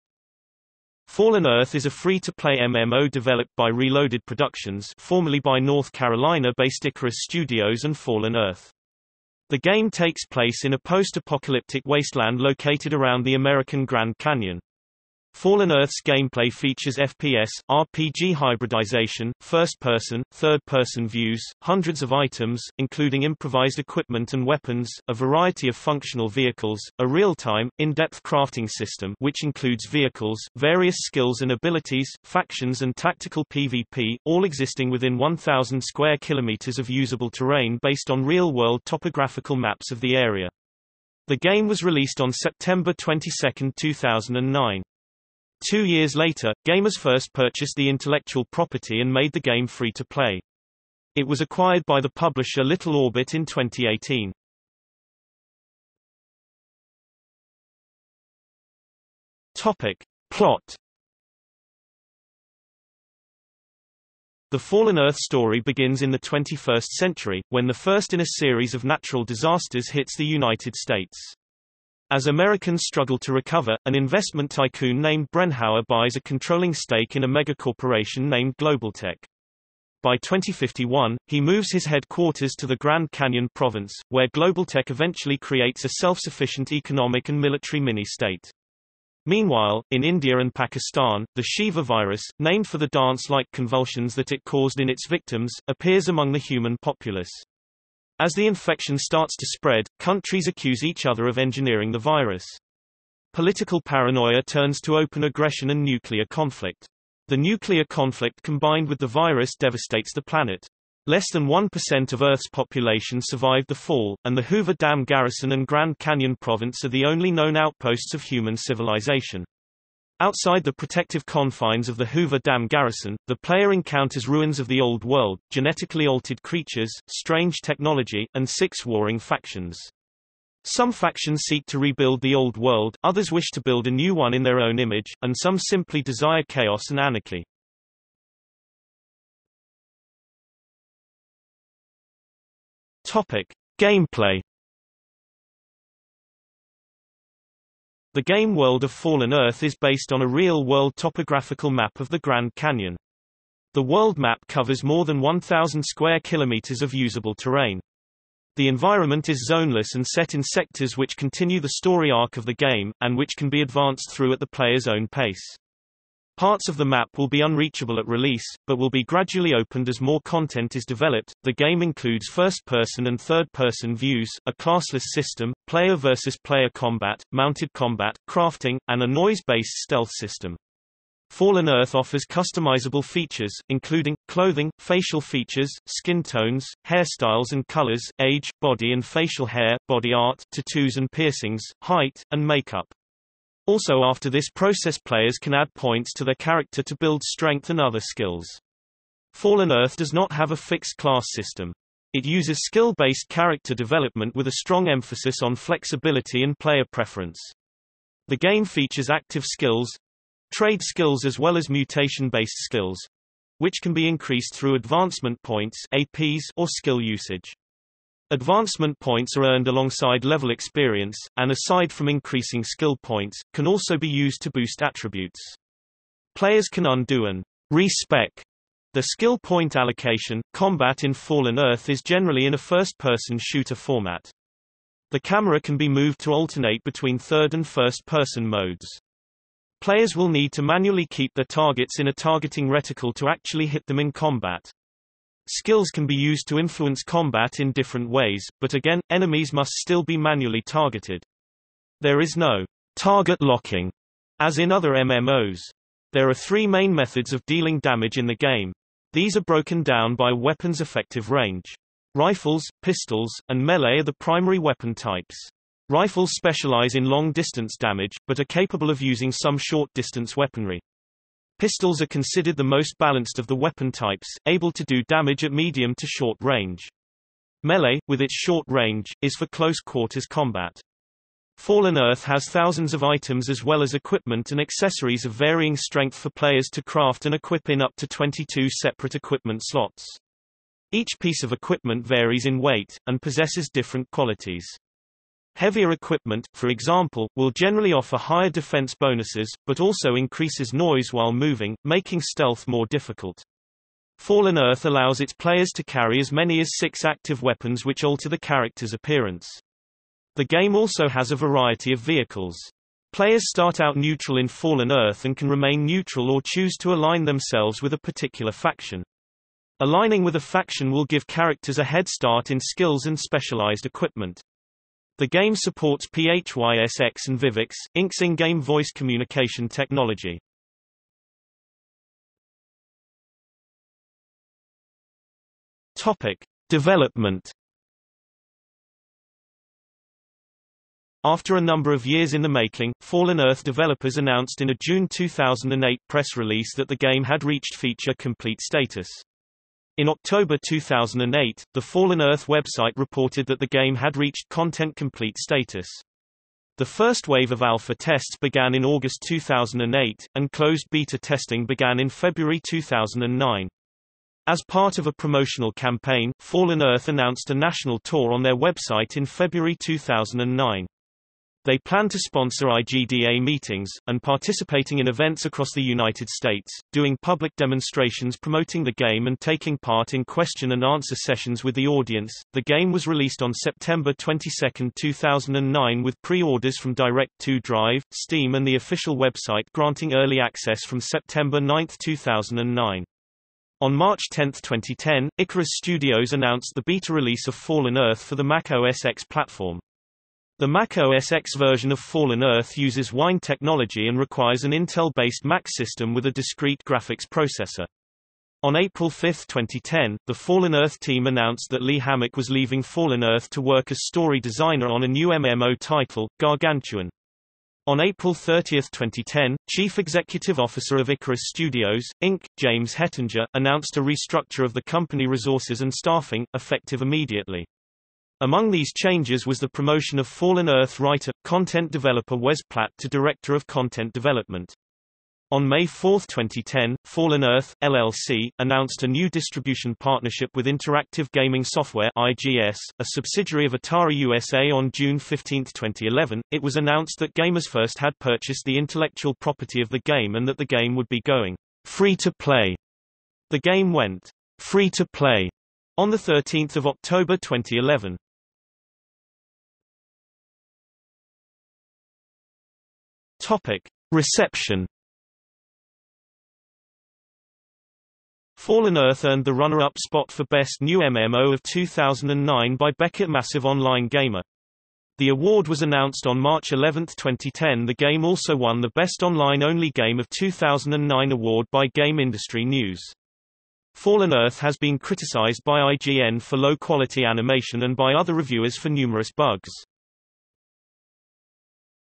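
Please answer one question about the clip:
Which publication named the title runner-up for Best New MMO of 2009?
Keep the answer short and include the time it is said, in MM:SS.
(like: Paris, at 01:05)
Beckett Massive Online Gamer, at 07:52.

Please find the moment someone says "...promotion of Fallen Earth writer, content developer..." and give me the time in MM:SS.
07:09.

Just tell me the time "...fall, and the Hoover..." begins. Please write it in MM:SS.
01:53.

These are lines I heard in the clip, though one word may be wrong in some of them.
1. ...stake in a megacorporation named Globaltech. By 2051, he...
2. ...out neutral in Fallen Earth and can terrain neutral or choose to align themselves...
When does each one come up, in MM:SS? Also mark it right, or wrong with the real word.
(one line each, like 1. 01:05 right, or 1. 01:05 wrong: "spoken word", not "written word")
1. 01:16 right
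2. 05:13 wrong: "remain", not "terrain".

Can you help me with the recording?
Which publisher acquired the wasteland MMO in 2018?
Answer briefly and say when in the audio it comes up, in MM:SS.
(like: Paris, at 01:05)
Little Orbit, at 00:52.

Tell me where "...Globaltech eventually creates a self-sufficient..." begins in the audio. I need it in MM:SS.
01:24.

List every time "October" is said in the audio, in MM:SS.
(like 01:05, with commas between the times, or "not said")
05:50, 07:36.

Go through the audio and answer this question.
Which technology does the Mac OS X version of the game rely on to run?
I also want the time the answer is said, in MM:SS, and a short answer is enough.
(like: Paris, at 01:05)
Wine, at 06:43.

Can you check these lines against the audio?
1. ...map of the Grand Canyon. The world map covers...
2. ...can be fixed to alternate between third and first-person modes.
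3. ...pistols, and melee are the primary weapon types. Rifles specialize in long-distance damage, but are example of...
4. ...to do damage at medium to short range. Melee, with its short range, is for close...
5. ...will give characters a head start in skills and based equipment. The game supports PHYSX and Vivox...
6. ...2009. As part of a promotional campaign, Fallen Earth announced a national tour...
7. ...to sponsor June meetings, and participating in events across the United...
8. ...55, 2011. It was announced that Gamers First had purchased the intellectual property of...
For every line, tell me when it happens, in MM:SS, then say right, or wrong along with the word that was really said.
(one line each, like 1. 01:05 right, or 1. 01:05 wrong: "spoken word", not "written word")
1. 02:31 right
2. 03:55 wrong: "moved", not "fixed"
3. 04:22 wrong: "capable", not "example"
4. 04:34 right
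5. 05:20 wrong: "specialized", not "based"
6. 06:02 right
7. 06:12 wrong: "IGDA", not "June"
8. 07:25 wrong: "15", not "55".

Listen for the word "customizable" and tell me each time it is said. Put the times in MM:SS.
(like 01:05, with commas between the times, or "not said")
03:02.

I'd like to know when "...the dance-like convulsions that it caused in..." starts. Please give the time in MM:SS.
01:32.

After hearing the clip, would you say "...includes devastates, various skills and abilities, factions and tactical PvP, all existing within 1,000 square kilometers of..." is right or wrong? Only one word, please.
wrong.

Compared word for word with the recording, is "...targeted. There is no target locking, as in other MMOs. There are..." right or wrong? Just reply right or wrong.
right.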